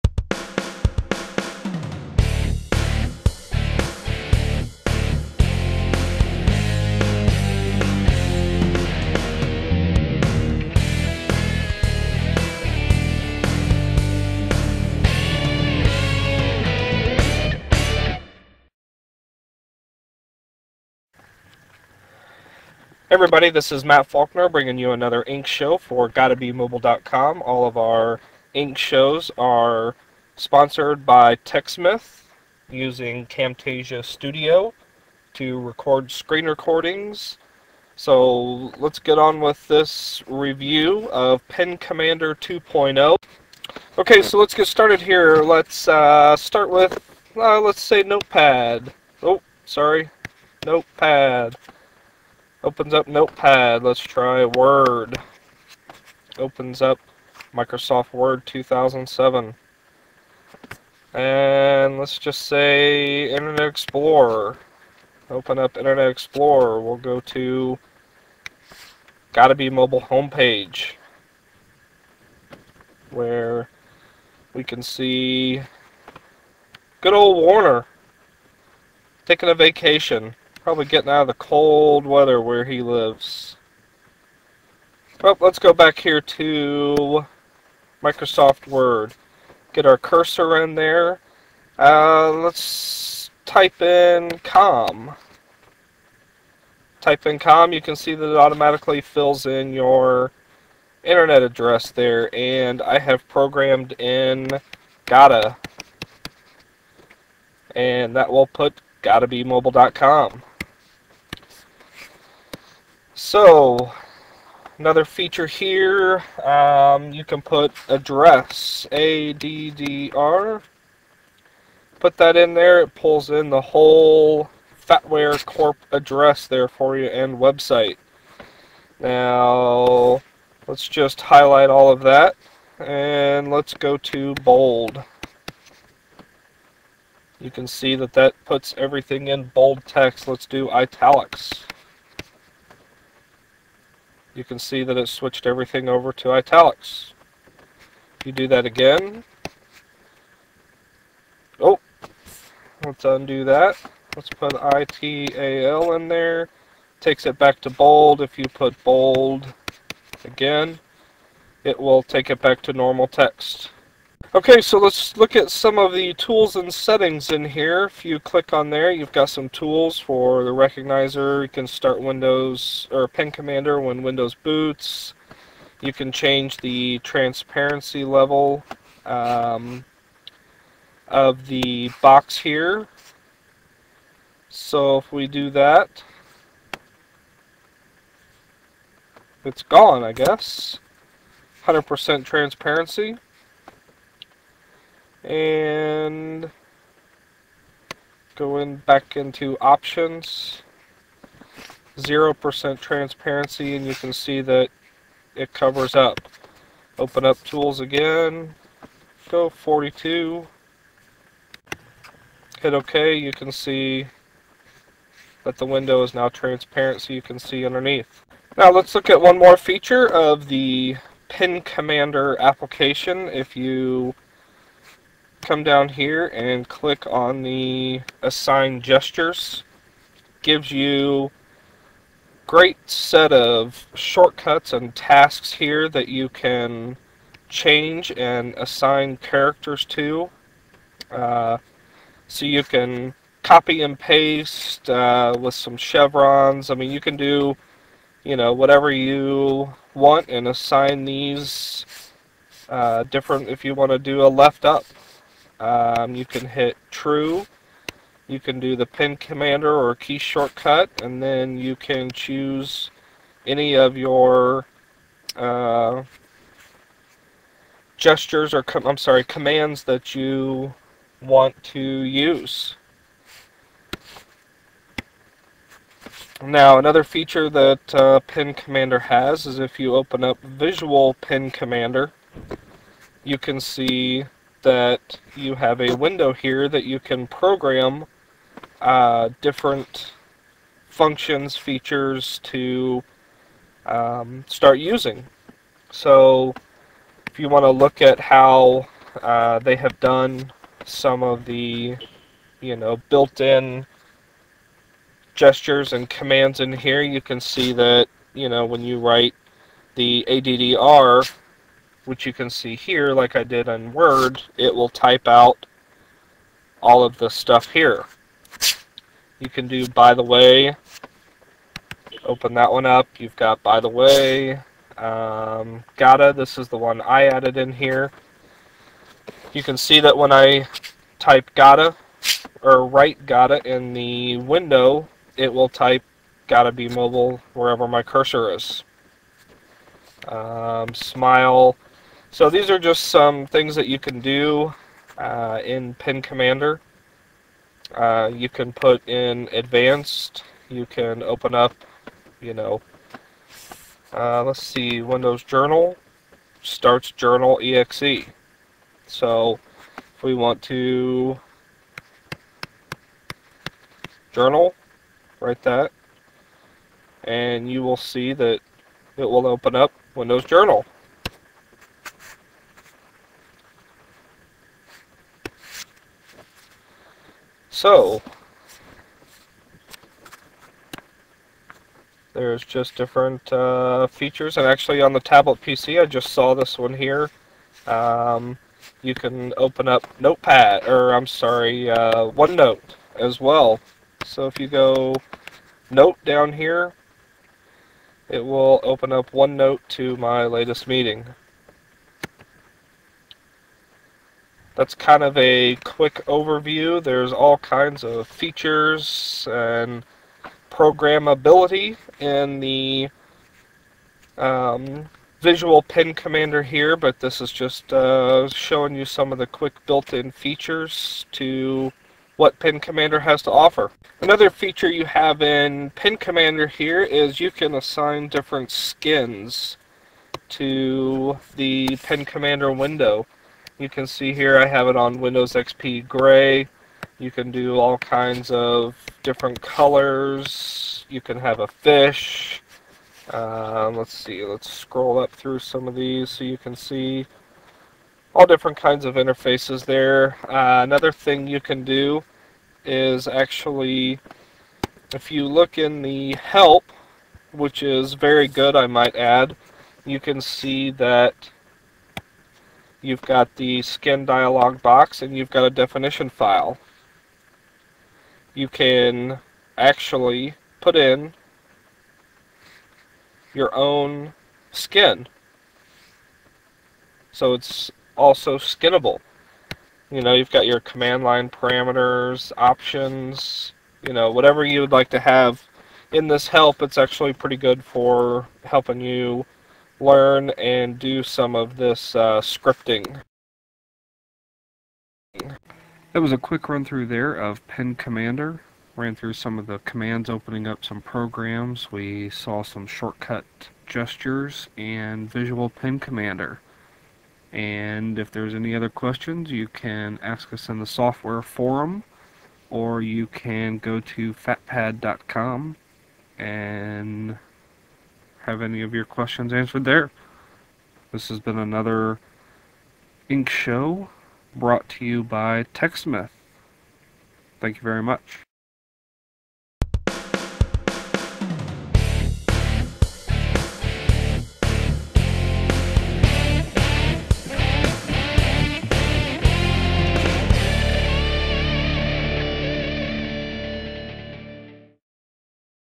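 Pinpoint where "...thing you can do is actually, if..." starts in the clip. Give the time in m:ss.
7:31.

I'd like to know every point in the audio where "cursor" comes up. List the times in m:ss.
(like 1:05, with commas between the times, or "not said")
1:29, 5:38.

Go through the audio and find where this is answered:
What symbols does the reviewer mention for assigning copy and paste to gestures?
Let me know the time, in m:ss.
4:05.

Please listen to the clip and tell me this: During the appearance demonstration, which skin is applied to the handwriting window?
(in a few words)
Windows XP Gray.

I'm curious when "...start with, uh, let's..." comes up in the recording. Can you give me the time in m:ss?
0:46.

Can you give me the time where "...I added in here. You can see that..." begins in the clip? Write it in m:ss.
5:27.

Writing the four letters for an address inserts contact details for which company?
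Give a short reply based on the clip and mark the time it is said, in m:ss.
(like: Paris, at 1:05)
Fatware Corp, at 2:04.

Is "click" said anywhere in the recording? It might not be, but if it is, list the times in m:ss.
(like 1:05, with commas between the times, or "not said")
2:48, 3:46.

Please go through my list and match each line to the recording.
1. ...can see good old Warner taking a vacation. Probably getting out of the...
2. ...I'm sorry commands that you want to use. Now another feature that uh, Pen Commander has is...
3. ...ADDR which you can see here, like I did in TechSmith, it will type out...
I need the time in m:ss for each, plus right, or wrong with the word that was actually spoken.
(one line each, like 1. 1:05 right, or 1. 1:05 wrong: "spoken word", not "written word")
1. 1:14 right
2. 4:28 right
3. 5:10 wrong: "Word", not "TechSmith".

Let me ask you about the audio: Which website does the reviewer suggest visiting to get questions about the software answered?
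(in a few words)
fatpad.com.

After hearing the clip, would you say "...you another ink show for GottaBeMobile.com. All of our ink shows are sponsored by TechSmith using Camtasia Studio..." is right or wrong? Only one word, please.
right.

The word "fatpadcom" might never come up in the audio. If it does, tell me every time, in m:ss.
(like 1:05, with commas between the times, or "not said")
8:34.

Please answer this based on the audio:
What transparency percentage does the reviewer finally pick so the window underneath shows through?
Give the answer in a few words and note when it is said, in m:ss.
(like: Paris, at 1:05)
42, at 3:29.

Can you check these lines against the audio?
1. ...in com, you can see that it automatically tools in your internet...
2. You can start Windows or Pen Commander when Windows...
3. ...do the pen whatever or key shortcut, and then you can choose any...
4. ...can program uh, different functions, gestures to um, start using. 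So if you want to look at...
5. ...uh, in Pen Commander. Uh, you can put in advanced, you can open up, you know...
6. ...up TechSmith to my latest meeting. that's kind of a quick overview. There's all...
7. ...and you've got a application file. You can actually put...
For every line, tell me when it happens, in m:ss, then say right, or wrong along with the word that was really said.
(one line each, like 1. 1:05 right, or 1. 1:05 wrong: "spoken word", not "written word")
1. 1:37 wrong: "fills", not "tools"
2. 2:51 right
3. 4:18 wrong: "commander", not "whatever"
4. 4:46 wrong: "features", not "gestures"
5. 5:45 right
6. 6:39 wrong: "OneNote", not "TechSmith"
7. 7:45 wrong: "definition", not "application".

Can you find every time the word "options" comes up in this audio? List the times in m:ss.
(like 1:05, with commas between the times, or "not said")
3:19, 8:02.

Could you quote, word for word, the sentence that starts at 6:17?
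So, there's just different uh, features, and actually on the tablet PC, I just saw this one here.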